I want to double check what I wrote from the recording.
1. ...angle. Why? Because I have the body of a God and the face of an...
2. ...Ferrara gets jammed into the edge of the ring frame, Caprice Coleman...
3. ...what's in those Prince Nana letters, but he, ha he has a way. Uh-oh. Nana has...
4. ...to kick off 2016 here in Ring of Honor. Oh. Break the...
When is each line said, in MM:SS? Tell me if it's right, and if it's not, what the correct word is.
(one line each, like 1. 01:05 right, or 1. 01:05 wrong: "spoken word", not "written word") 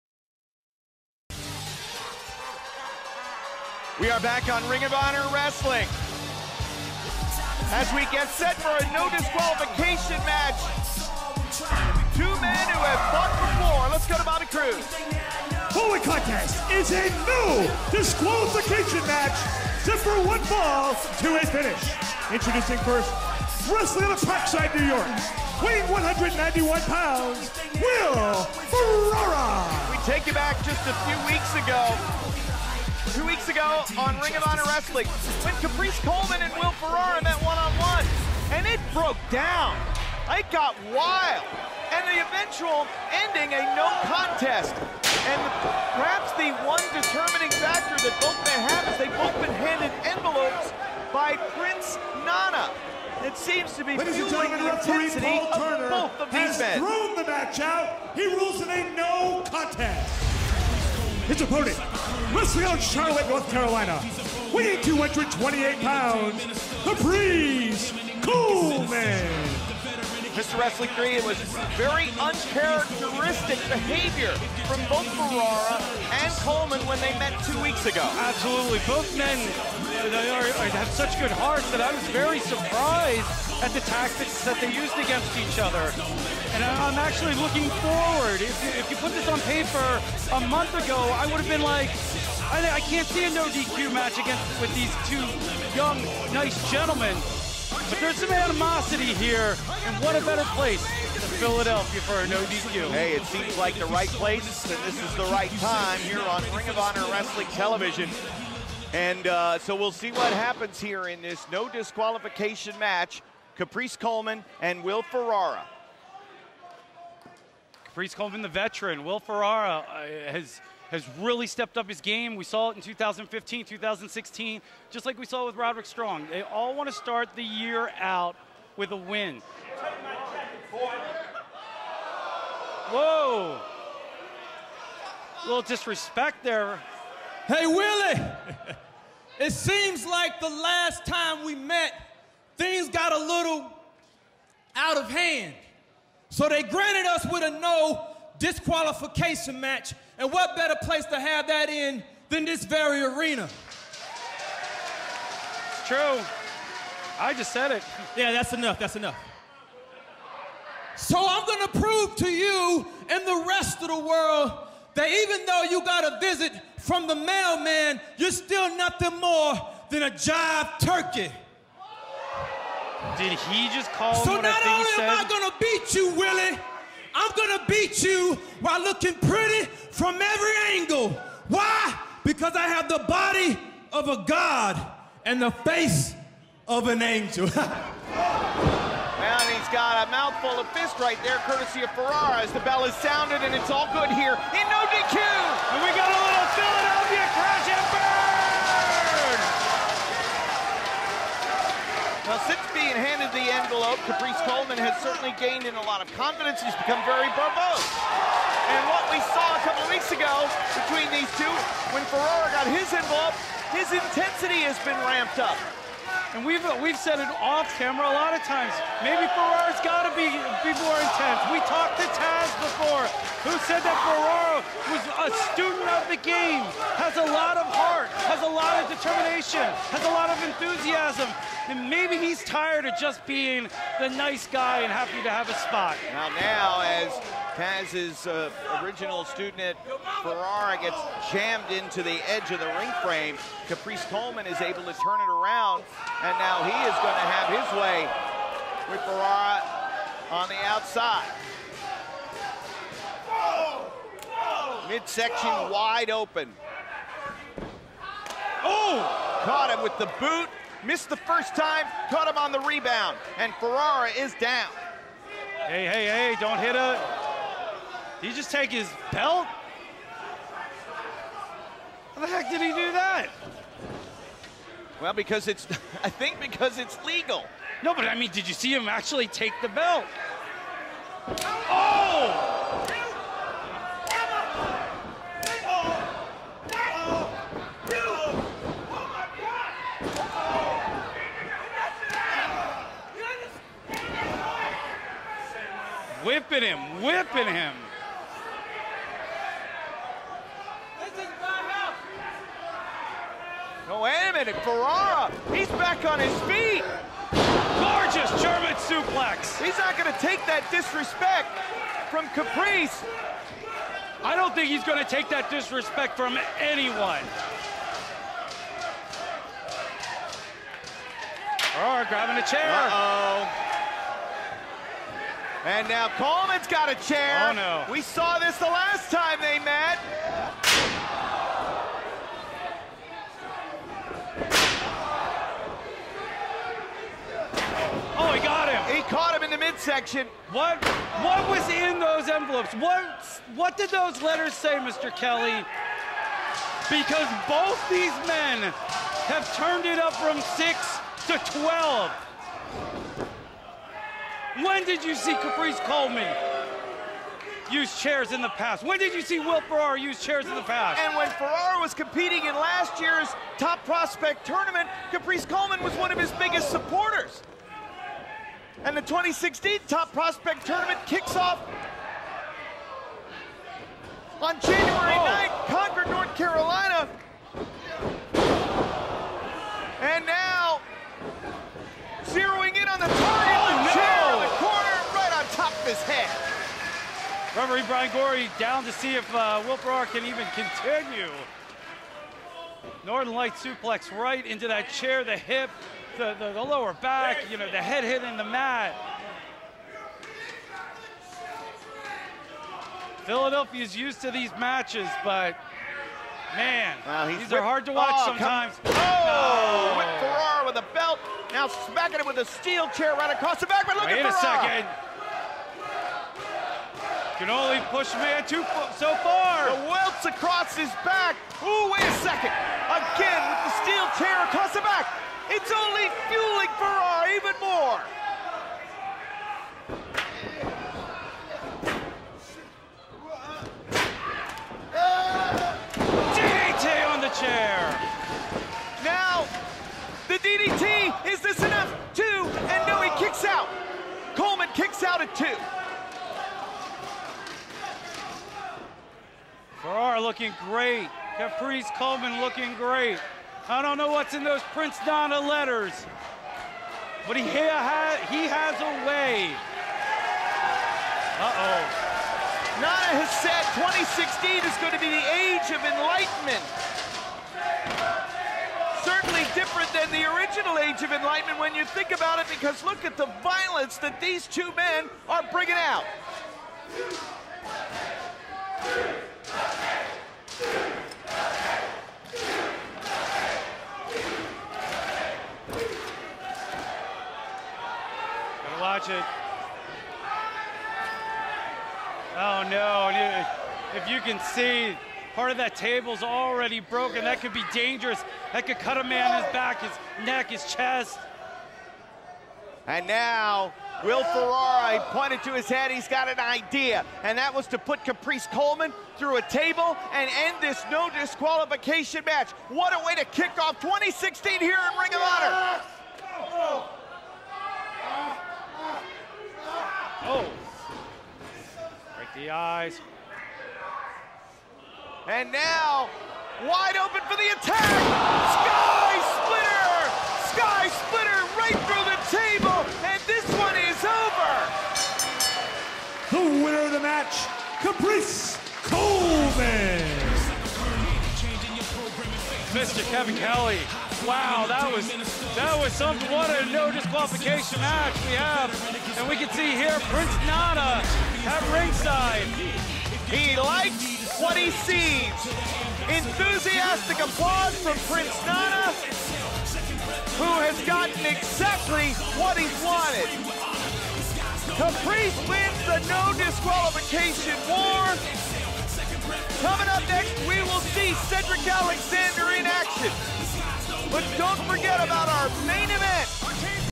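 1. 03:00 right
2. 04:00 right
3. 07:34 right
4. 08:33 right.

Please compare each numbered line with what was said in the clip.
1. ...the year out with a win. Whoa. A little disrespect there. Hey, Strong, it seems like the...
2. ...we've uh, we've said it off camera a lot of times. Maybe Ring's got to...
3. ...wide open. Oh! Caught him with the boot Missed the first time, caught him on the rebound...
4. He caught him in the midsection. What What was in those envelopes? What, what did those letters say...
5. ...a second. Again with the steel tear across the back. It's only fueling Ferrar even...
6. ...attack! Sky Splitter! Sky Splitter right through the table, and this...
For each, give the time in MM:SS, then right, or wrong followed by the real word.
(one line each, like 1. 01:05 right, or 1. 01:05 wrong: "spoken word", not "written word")
1. 02:07 wrong: "Willie", not "Strong"
2. 03:36 wrong: "Ferrara", not "Ring"
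3. 04:15 right
4. 05:38 right
5. 07:02 right
6. 08:47 right.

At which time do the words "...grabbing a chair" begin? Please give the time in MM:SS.
05:22.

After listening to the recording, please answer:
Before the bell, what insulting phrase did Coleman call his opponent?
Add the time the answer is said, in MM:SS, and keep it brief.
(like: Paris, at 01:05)
jive turkey, at 02:50.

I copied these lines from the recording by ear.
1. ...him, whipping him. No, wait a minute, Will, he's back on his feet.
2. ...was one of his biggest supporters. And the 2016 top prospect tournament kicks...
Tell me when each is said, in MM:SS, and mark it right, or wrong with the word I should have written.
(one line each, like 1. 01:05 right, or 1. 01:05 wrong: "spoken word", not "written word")
1. 04:56 wrong: "Ferrara", not "Will"
2. 06:05 right.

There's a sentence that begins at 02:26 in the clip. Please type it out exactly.
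So they granted us with a no, disqualification match.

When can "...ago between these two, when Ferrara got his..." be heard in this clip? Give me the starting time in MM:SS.
03:30.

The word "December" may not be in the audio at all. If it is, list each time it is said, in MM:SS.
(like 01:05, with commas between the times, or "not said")
not said.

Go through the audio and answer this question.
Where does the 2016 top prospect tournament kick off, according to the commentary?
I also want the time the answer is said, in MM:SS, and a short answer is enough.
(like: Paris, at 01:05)
Concord, North Carolina, at 06:15.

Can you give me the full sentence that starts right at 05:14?
I don't think he's gonna take that disrespect from anyone.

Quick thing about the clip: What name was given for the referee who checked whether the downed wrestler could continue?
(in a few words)
Brian Gorey.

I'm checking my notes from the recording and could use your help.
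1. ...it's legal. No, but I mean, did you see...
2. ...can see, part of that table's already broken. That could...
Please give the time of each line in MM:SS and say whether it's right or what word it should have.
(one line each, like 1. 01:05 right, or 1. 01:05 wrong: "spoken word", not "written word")
1. 04:36 right
2. 08:14 right.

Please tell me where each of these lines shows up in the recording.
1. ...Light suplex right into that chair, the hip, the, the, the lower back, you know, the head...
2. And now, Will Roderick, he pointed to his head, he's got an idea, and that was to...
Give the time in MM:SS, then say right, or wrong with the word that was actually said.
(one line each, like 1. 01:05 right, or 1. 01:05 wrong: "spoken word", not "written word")
1. 06:33 right
2. 08:22 wrong: "Ferrara", not "Roderick".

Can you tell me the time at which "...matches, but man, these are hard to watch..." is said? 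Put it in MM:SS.
06:44.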